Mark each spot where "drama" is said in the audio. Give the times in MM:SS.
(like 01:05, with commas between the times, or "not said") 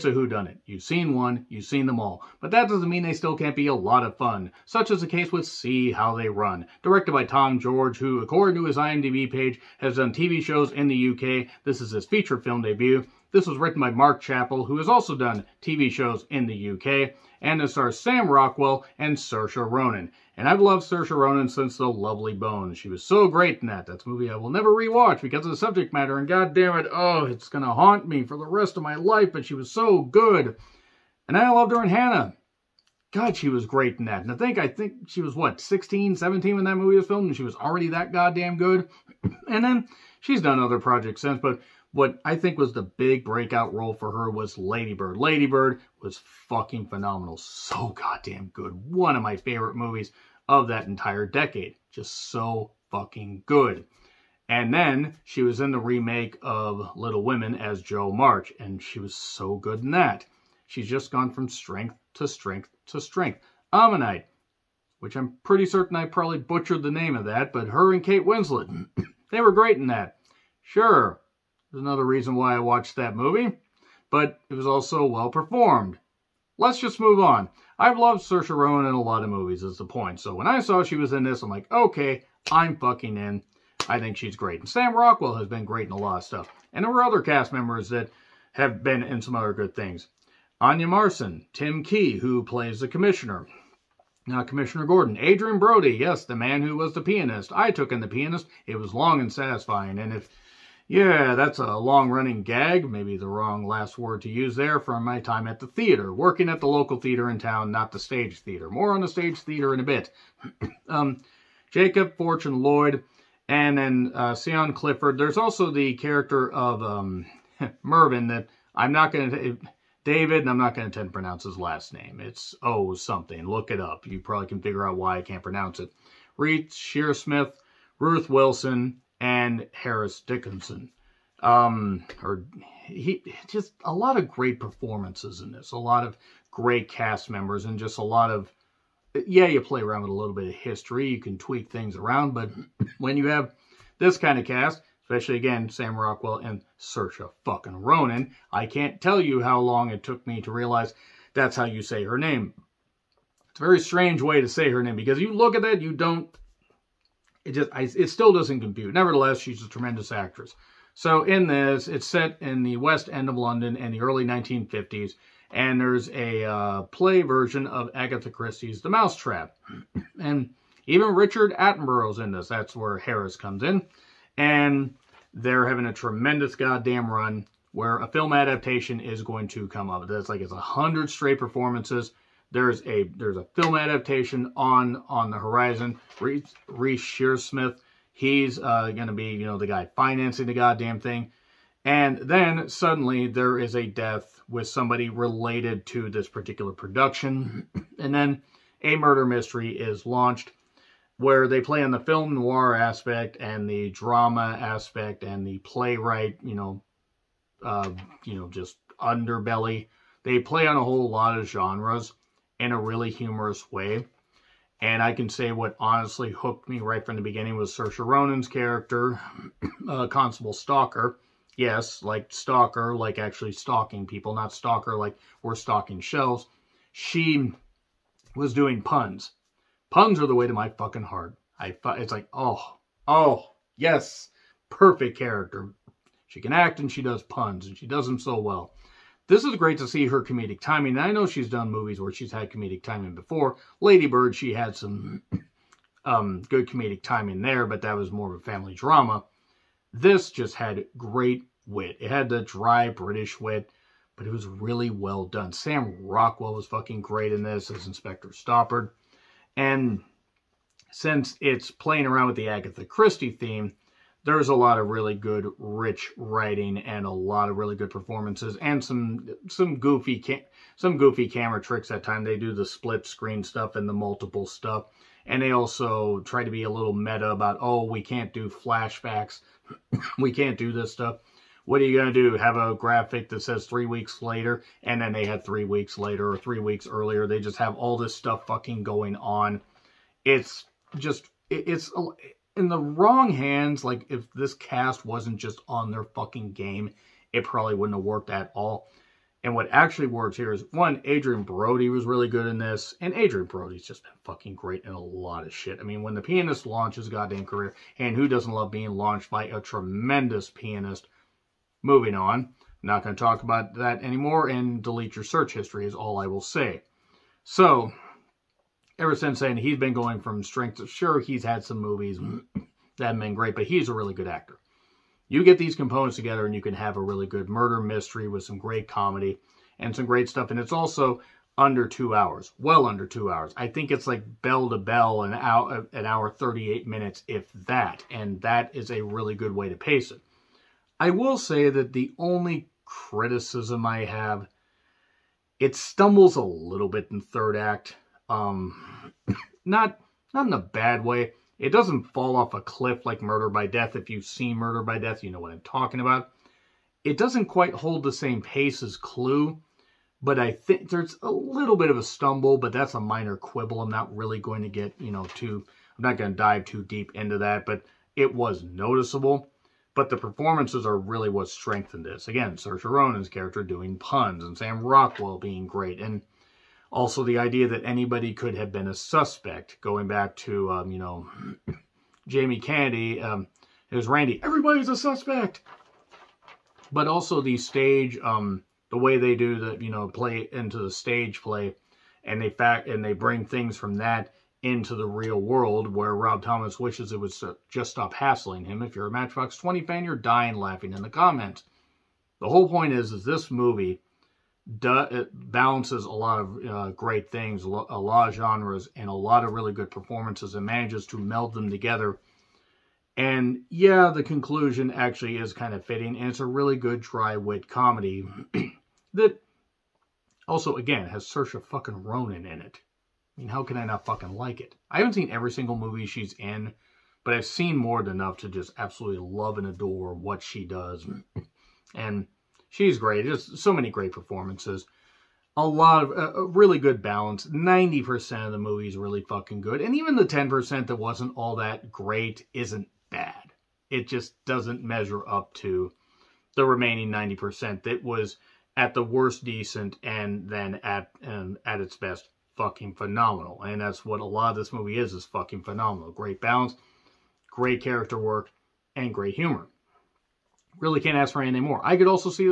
03:23, 04:08.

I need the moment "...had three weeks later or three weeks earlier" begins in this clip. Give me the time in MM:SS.
04:45.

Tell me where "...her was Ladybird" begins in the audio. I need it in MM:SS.
00:44.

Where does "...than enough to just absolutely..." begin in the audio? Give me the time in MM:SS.
07:08.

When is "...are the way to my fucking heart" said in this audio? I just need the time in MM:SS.
03:50.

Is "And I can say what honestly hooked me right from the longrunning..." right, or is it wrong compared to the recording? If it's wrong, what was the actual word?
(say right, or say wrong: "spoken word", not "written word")
wrong: "beginning", not "longrunning".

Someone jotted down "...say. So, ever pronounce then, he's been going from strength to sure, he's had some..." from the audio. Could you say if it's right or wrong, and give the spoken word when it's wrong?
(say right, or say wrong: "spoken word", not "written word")
wrong: "since", not "pronounce".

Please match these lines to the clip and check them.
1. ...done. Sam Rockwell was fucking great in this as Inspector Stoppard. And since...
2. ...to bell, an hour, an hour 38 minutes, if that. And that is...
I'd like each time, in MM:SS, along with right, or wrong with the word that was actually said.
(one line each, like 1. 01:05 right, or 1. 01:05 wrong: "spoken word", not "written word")
1. 04:15 right
2. 05:34 right.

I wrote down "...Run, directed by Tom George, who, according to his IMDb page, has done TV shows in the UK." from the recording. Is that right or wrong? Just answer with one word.
right.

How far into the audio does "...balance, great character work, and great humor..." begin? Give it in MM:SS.
07:36.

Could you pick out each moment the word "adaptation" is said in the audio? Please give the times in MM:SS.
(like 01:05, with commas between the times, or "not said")
02:58, 03:03.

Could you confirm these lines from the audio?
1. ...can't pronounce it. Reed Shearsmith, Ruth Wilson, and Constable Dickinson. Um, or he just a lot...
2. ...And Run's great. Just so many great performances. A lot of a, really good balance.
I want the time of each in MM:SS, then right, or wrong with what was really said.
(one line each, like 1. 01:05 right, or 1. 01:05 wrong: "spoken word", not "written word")
1. 02:05 wrong: "Harris", not "Constable"
2. 07:11 wrong: "She", not "Run".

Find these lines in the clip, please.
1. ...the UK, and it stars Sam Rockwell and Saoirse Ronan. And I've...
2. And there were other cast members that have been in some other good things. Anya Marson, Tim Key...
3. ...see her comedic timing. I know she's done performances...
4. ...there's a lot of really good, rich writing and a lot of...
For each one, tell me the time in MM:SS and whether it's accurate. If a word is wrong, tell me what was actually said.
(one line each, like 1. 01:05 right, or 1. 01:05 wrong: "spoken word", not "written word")
1. 00:16 right
2. 01:26 right
3. 03:59 wrong: "movies", not "performances"
4. 04:24 right.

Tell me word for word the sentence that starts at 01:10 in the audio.
Sure, there's another reason why I watched that movie, but it was also well performed.